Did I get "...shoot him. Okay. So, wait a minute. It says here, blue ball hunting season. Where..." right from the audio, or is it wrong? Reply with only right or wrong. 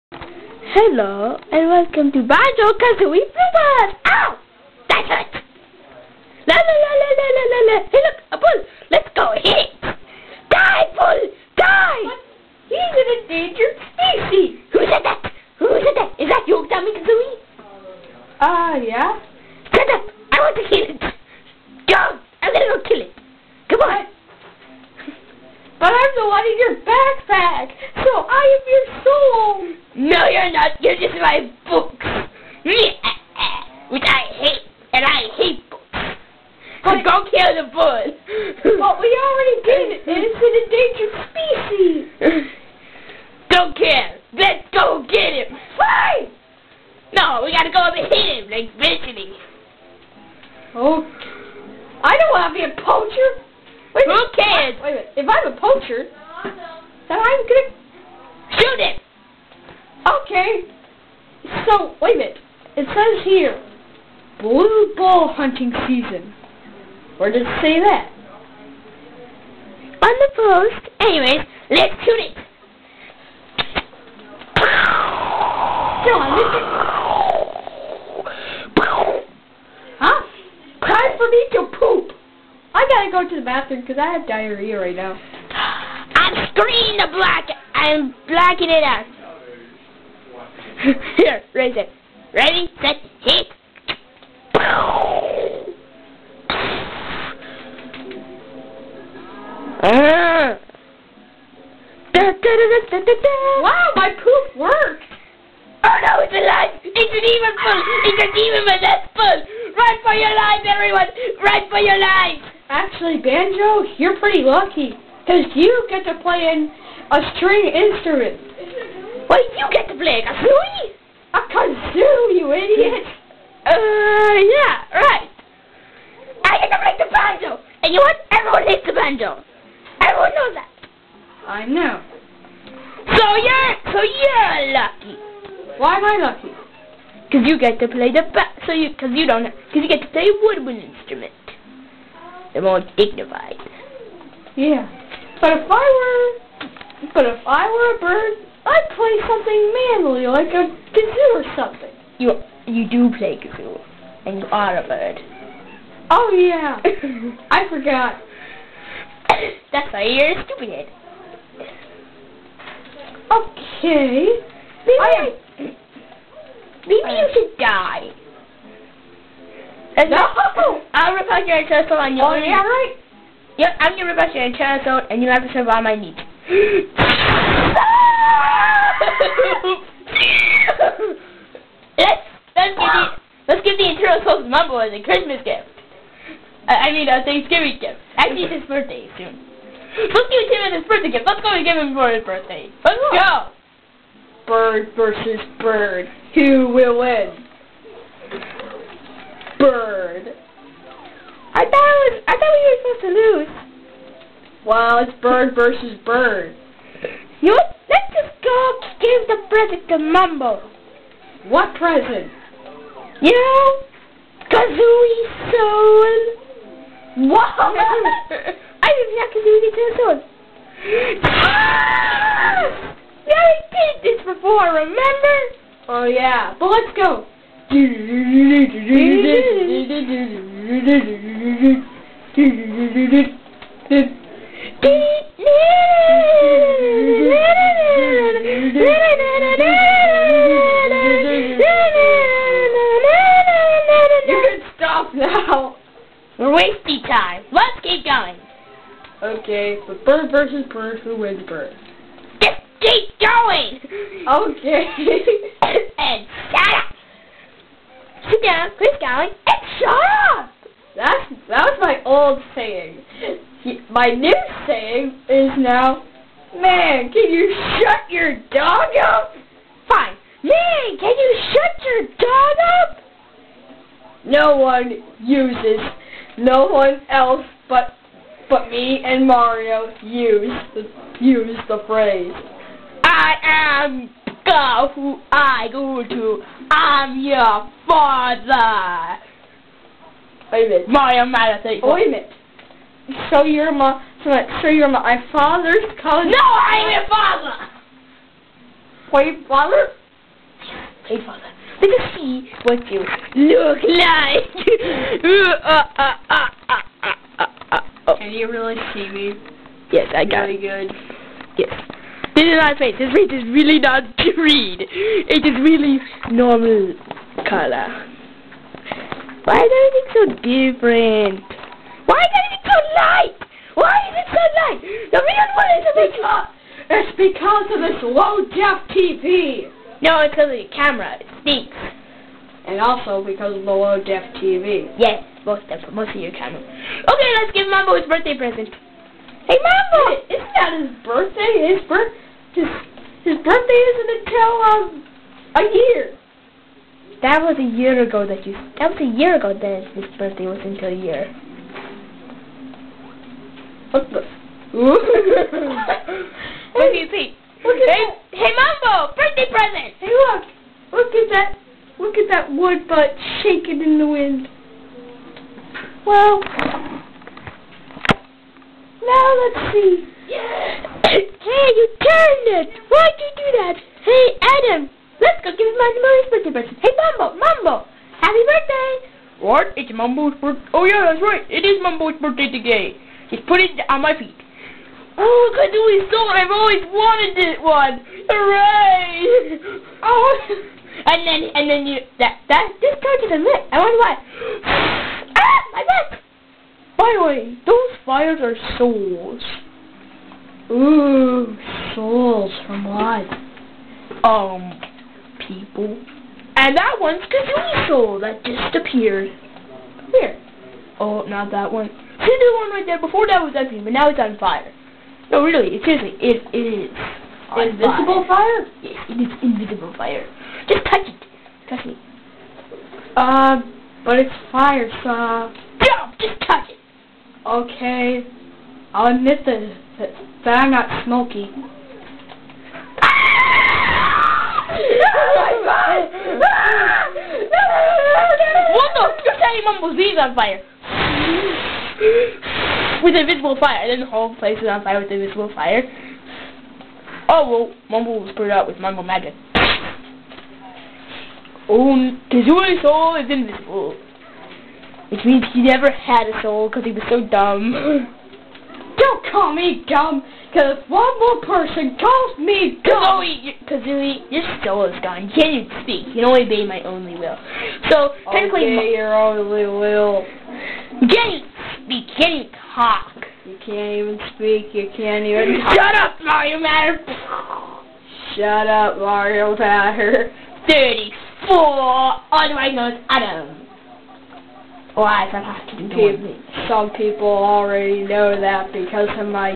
right.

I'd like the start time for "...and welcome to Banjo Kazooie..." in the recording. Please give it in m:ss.
0:01.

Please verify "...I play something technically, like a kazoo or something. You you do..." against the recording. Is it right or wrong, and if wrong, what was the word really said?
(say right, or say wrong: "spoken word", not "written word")
wrong: "manly", not "technically".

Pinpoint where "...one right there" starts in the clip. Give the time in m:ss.
6:52.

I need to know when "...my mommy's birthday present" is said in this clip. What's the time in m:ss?
6:15.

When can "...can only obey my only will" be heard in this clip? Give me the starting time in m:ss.
7:46.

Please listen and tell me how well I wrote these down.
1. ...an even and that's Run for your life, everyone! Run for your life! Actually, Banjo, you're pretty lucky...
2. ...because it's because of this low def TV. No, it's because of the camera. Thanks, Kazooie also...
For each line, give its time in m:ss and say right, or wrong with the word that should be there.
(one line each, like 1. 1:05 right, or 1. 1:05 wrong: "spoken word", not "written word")
1. 1:48 right
2. 5:26 wrong: "And", not "Kazooie".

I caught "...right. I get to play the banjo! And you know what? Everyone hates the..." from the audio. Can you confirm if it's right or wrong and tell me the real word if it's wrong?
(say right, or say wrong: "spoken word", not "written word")
right.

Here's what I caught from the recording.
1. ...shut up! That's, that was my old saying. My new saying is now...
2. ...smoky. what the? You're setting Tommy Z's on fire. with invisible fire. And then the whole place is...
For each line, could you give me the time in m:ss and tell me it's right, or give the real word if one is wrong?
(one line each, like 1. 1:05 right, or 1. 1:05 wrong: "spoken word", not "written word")
1. 4:19 right
2. 7:11 wrong: "Mumble", not "Tommy".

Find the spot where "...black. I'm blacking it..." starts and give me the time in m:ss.
1:27.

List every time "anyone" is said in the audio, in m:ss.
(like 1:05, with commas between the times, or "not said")
not said.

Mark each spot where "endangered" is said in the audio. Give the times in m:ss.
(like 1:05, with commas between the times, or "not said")
0:13, 0:42.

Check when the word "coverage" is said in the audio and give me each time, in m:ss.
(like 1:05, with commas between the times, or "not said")
not said.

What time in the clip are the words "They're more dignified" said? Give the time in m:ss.
2:22.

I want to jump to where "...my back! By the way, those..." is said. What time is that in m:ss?
6:35.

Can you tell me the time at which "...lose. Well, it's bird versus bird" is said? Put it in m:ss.
3:23.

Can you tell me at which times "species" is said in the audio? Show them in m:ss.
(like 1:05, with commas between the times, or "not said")
0:13, 0:42.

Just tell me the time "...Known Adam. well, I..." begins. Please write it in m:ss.
8:02.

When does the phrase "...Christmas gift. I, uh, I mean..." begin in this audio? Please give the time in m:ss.
3:05.